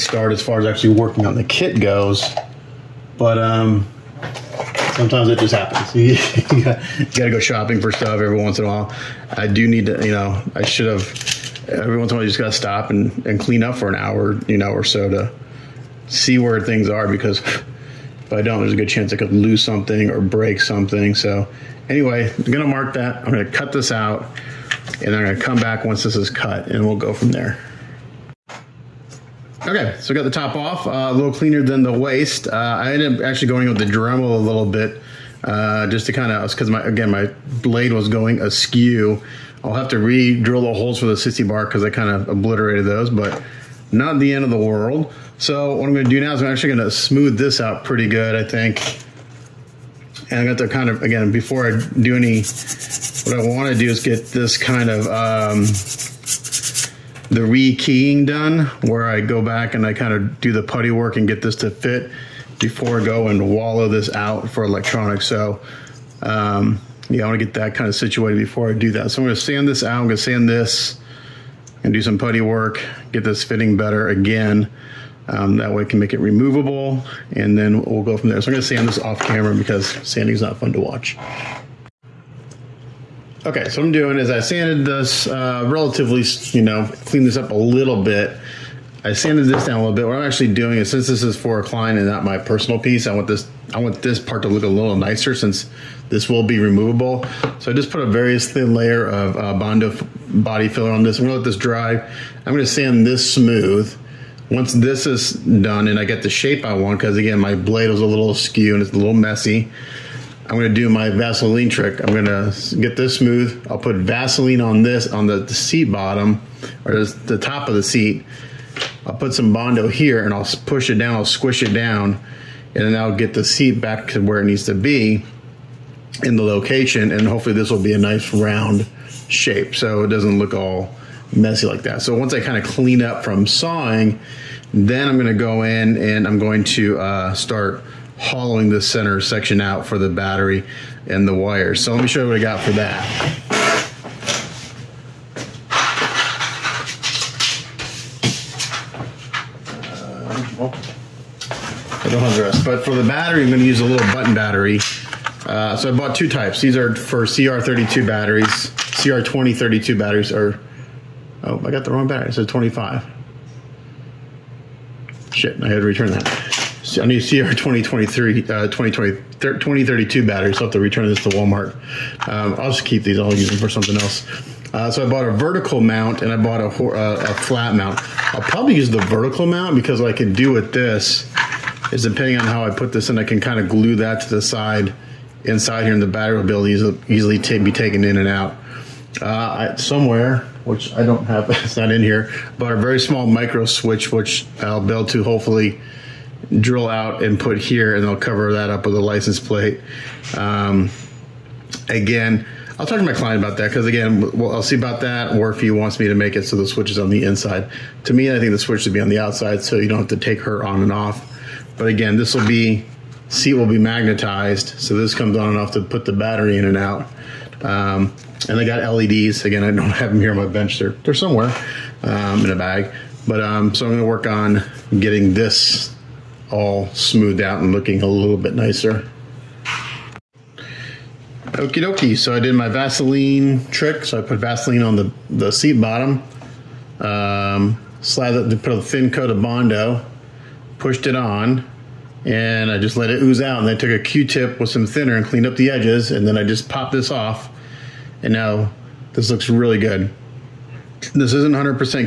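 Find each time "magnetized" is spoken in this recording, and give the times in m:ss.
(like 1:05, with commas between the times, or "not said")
3:33.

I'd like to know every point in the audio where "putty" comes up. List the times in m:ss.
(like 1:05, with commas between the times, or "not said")
1:00, 1:12.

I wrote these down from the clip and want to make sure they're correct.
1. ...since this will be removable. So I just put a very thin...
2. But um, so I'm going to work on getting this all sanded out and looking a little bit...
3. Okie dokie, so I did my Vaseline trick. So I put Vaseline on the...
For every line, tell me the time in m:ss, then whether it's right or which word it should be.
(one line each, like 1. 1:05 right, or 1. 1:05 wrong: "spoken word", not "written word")
1. 1:35 right
2. 3:43 wrong: "smoothed", not "sanded"
3. 3:51 right.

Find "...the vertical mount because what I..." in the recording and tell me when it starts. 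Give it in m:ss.
2:58.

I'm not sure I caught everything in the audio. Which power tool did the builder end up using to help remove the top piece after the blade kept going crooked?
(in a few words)
Dremel.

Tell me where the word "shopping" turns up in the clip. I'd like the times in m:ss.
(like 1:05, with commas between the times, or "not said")
0:07.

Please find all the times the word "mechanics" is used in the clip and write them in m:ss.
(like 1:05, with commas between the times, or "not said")
not said.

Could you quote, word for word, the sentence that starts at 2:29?
Uh, I don't have the rest, but for the battery, I'm going to use a little button battery.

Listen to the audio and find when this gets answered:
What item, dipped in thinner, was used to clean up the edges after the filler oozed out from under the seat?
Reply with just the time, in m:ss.
4:03.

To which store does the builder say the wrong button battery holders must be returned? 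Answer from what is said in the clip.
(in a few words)
Walmart.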